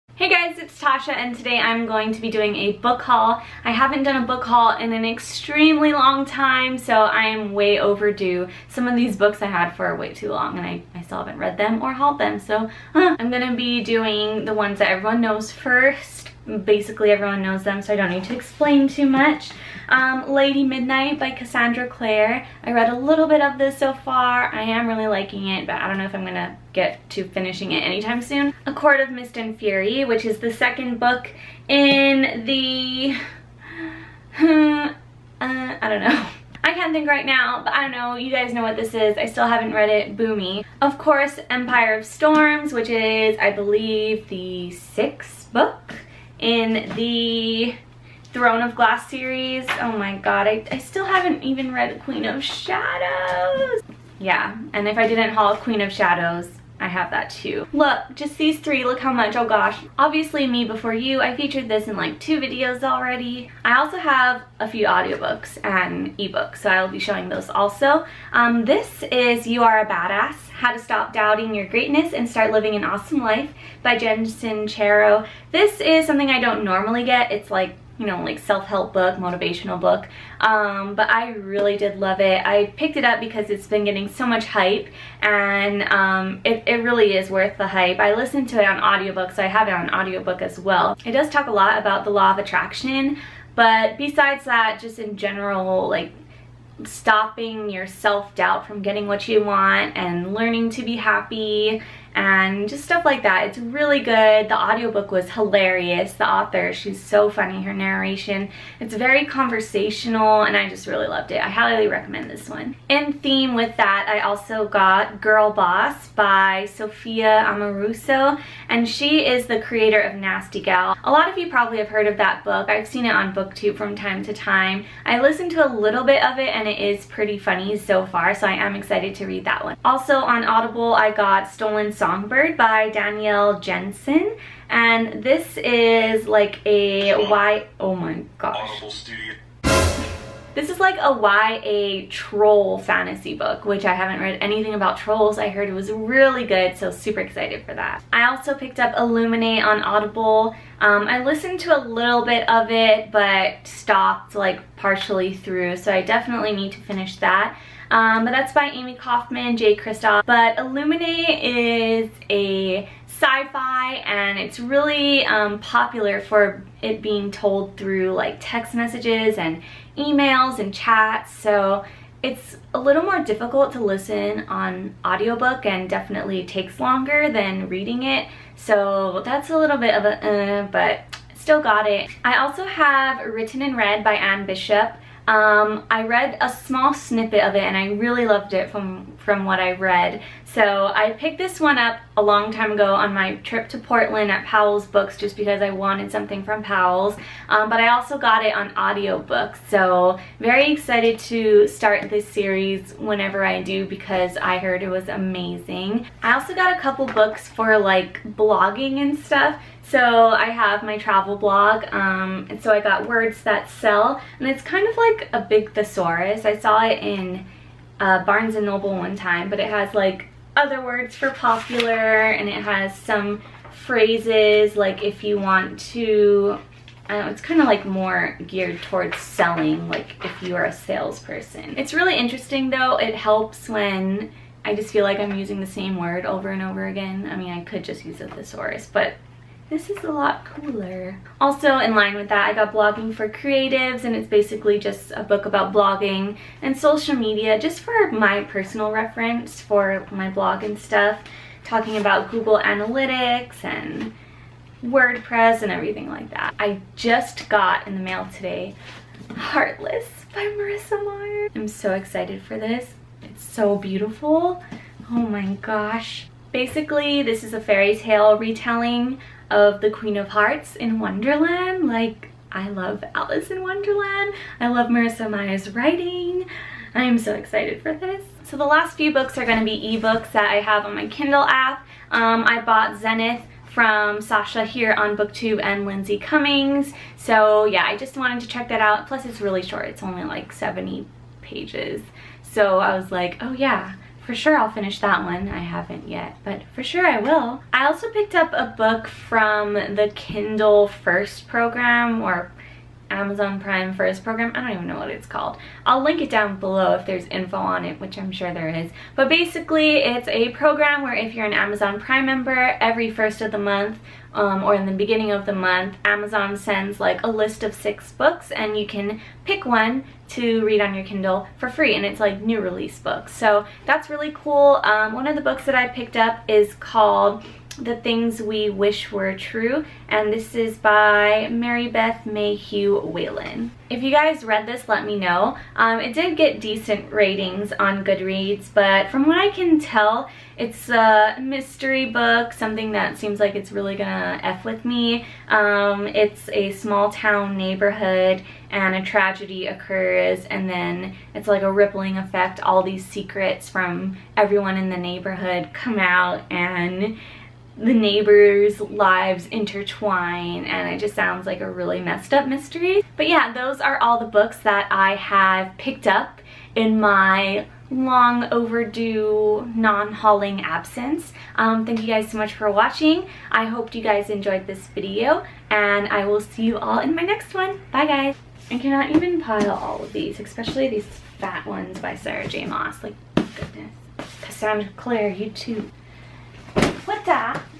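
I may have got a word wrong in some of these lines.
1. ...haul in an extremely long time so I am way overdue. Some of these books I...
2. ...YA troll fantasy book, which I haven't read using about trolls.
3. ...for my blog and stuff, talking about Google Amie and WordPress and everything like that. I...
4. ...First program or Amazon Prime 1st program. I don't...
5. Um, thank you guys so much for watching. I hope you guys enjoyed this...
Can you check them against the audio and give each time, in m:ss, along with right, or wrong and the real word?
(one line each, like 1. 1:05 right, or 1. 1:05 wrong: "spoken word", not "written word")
1. 0:04 right
2. 2:21 wrong: "anything", not "using"
3. 4:09 wrong: "Analytics", not "Amie"
4. 5:00 right
5. 6:11 right.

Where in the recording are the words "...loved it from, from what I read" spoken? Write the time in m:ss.
3:08.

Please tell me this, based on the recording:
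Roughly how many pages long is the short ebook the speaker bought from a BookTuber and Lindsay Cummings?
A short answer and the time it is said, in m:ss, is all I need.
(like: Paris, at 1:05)
70, at 4:50.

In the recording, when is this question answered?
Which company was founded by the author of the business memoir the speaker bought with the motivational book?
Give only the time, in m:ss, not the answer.
2:00.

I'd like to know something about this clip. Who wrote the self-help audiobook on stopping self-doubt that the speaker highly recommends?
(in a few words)
Jen Sincero.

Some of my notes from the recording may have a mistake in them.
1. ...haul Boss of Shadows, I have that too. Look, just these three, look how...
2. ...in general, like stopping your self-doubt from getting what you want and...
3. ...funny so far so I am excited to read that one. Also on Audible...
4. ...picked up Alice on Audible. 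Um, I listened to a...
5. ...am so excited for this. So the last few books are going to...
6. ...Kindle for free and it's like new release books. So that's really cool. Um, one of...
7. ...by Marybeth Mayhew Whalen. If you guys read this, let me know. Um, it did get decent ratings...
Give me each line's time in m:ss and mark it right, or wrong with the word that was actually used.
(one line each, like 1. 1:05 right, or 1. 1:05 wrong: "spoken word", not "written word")
1. 0:55 wrong: "Queen", not "Boss"
2. 1:34 right
3. 2:07 right
4. 2:28 wrong: "Illuminae", not "Alice"
5. 4:37 right
6. 5:21 right
7. 5:30 right.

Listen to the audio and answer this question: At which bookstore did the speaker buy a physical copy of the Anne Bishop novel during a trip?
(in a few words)
Powell's Books.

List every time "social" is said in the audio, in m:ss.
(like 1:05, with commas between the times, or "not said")
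4:06.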